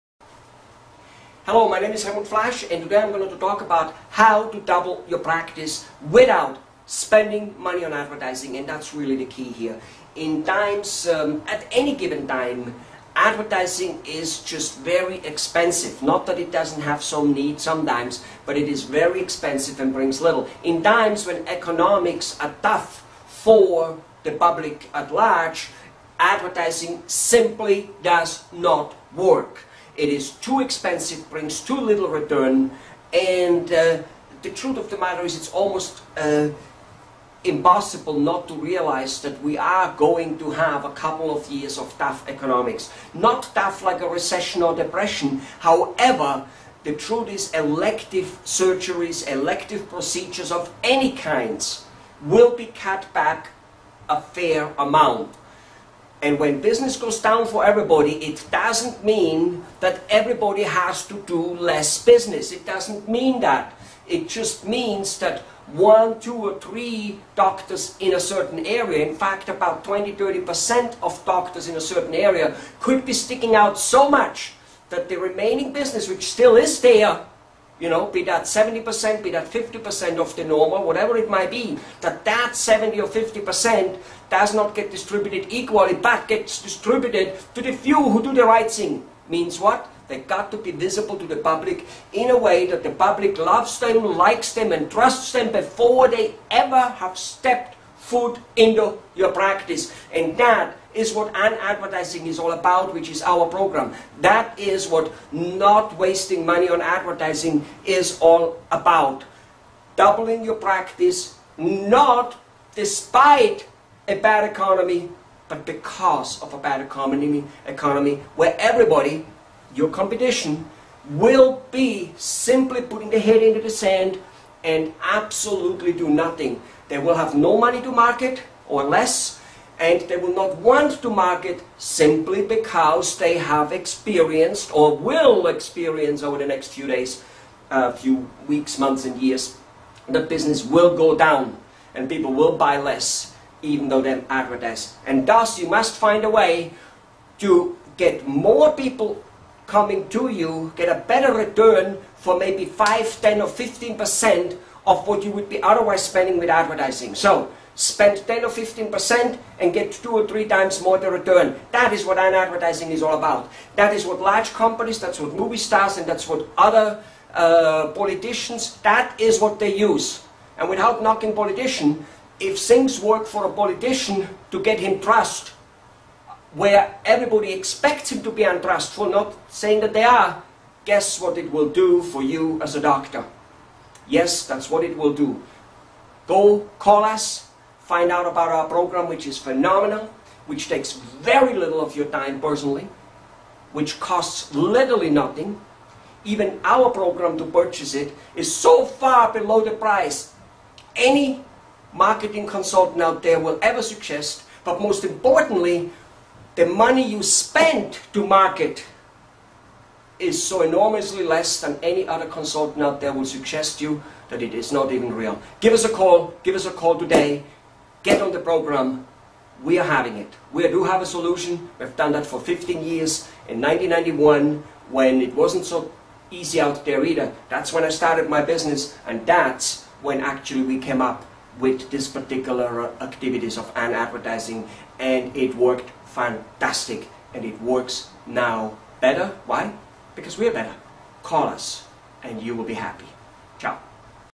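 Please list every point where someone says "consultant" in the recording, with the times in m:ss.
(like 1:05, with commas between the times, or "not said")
3:22, 3:32.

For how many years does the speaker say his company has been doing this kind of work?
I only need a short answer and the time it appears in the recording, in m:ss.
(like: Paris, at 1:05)
15 years, at 3:42.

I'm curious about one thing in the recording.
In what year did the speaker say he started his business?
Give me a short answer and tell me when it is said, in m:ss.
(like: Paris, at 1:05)
1991, at 3:43.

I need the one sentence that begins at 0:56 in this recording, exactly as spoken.
And when business goes down for everybody, it doesn't mean that everybody has to do less business.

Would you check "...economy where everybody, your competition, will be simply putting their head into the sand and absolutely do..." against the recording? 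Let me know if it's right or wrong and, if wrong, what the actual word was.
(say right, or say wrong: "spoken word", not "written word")
right.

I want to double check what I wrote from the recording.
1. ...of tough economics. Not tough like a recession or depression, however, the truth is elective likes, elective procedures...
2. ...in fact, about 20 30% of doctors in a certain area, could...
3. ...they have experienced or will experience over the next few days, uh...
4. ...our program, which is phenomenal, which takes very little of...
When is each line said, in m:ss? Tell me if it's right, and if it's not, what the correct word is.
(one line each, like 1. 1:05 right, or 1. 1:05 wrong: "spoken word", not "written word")
1. 0:41 wrong: "surgeries", not "likes"
2. 1:09 right
3. 2:13 right
4. 3:08 right.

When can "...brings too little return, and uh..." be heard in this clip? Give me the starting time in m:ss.
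0:31.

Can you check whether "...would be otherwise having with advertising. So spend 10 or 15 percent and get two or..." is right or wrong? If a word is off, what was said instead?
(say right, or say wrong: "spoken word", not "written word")
wrong: "spending", not "having".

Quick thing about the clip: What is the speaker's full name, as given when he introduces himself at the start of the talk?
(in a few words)
Helmut Flasch.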